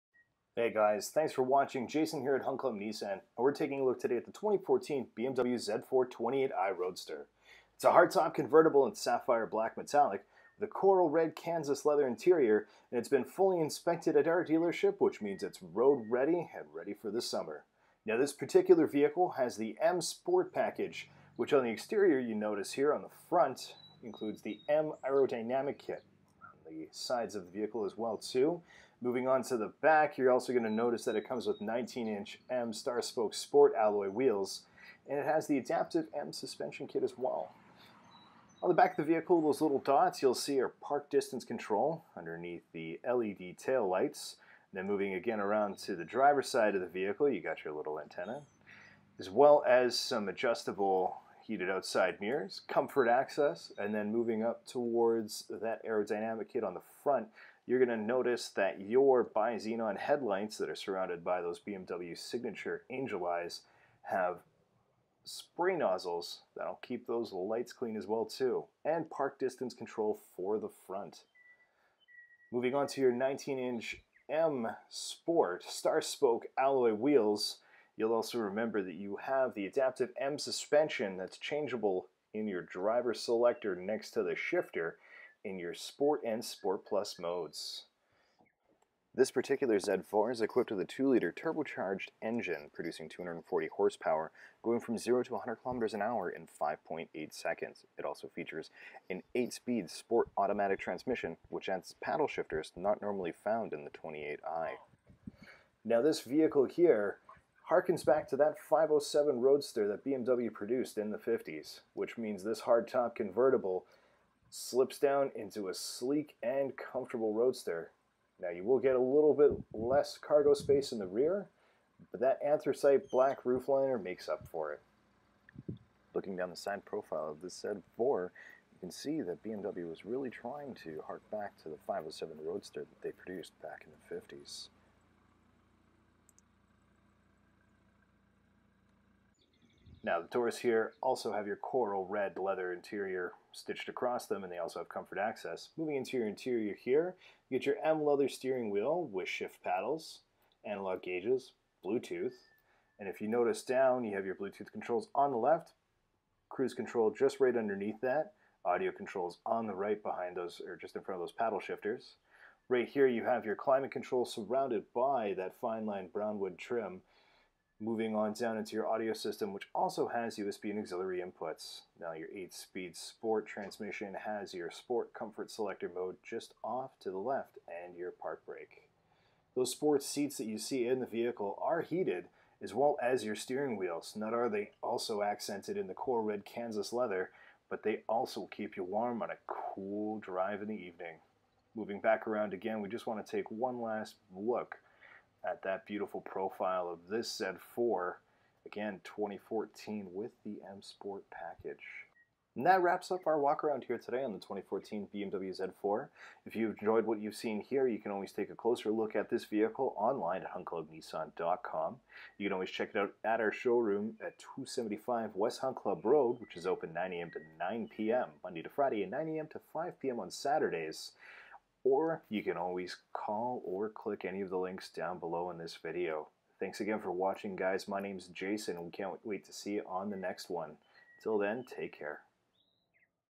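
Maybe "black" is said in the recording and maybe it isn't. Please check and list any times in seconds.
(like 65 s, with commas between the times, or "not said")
9 s, 123 s.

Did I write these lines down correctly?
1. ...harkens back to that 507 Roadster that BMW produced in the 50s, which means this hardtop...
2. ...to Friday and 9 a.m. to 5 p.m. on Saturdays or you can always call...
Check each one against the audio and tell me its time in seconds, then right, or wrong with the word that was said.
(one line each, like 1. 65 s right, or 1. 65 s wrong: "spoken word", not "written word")
1. 107 s right
2. 218 s right.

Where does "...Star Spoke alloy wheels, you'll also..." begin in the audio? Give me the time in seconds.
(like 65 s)
75 s.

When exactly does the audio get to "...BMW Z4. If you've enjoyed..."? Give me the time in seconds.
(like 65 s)
205 s.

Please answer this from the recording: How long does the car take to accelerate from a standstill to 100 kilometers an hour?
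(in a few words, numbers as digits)
5.8 seconds.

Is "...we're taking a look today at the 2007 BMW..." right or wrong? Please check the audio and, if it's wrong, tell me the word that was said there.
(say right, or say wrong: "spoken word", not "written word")
wrong: "2014", not "2007".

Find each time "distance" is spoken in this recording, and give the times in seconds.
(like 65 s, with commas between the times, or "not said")
41 s, 69 s.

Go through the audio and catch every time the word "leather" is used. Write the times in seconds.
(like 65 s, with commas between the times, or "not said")
11 s, 142 s, 148 s, 186 s.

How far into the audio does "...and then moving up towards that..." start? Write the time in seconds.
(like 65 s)
53 s.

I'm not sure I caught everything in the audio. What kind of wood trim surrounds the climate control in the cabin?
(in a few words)
Fine line brown wood.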